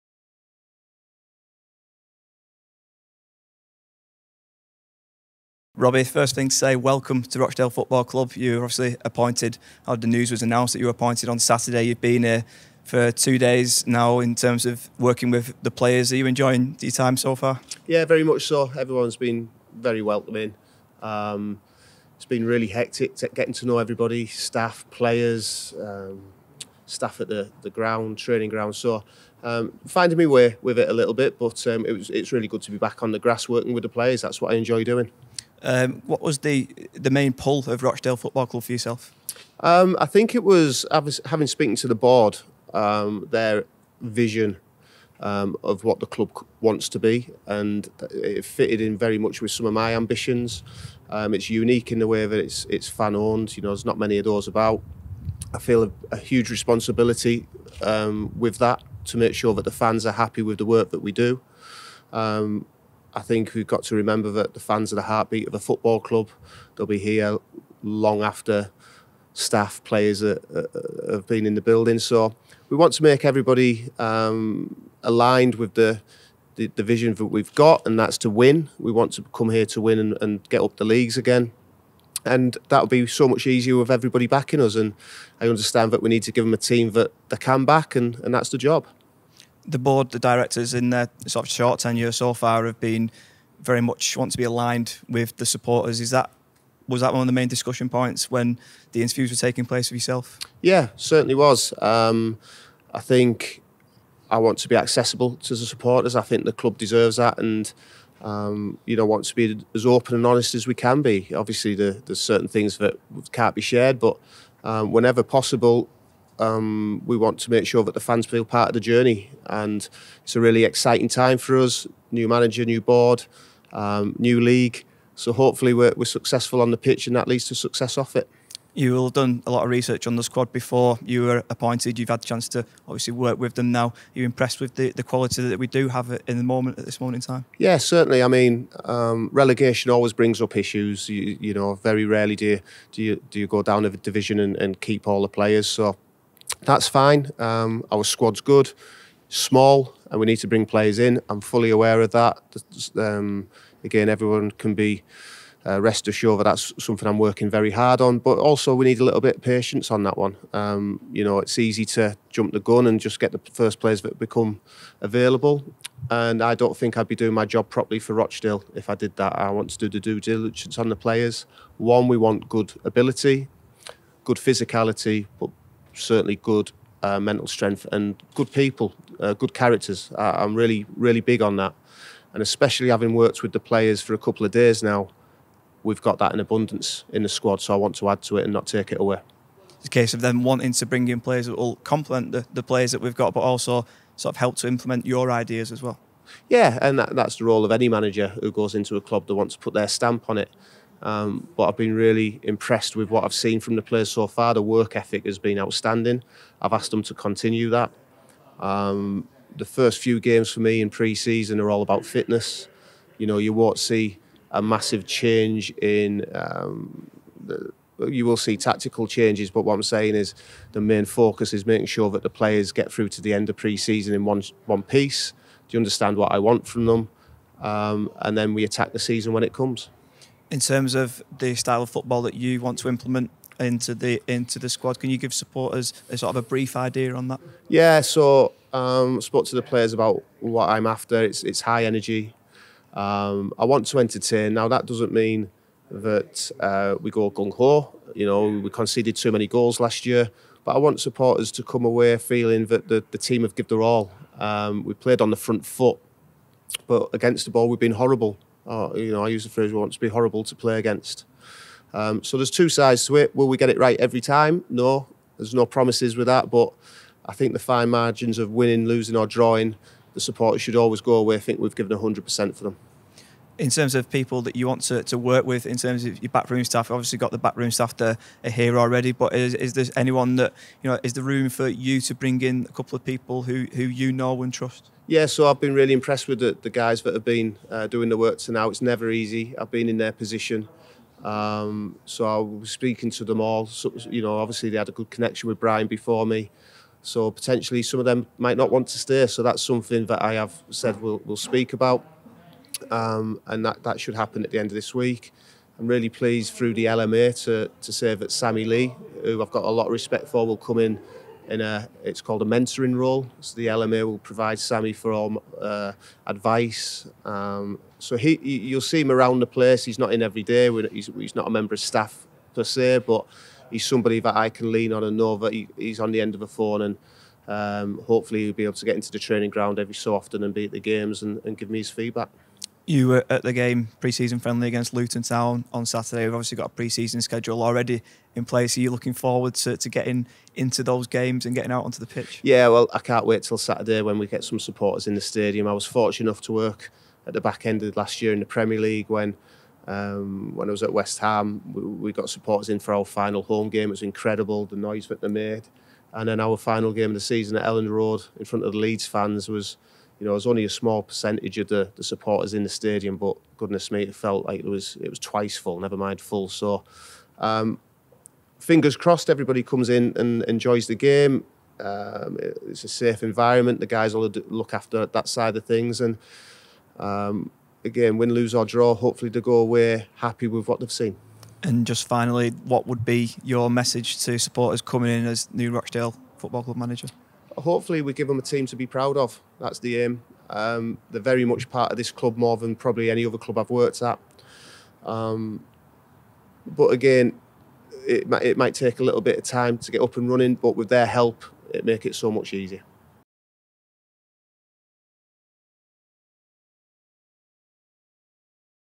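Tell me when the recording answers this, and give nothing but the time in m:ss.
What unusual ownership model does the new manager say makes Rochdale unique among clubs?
0:52.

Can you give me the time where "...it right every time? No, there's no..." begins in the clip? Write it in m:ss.
4:23.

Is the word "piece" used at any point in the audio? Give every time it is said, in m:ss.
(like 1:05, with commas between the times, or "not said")
3:44.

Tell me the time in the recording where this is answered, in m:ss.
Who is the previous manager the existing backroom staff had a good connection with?
4:55.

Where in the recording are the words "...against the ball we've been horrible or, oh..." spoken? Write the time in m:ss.
4:17.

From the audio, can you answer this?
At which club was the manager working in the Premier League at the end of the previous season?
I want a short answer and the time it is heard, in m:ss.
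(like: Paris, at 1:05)
West Brom, at 5:50.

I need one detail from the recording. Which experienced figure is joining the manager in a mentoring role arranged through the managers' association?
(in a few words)
Sammy Lee.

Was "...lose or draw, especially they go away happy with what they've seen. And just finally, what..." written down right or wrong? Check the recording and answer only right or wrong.
wrong.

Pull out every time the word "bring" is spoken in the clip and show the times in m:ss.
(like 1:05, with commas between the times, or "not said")
2:20, 2:30, 3:10, 4:42.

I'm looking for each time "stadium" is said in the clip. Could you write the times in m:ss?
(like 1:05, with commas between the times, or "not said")
5:45, 6:02.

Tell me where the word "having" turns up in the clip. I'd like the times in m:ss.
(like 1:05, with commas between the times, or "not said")
0:40, 3:02.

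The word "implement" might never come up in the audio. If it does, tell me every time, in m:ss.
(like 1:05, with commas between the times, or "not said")
3:14, 3:52.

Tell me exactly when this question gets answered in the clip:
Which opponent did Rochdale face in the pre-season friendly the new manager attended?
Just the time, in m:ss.
5:34.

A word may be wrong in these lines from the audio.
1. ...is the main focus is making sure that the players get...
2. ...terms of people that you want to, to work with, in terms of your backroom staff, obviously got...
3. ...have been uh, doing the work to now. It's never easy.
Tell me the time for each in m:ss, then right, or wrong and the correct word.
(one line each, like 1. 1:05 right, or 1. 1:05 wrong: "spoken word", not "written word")
1. 3:40 right
2. 4:33 right
3. 4:47 right.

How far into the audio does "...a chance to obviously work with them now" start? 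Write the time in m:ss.
2:12.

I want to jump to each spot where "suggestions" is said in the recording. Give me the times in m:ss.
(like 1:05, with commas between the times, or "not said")
not said.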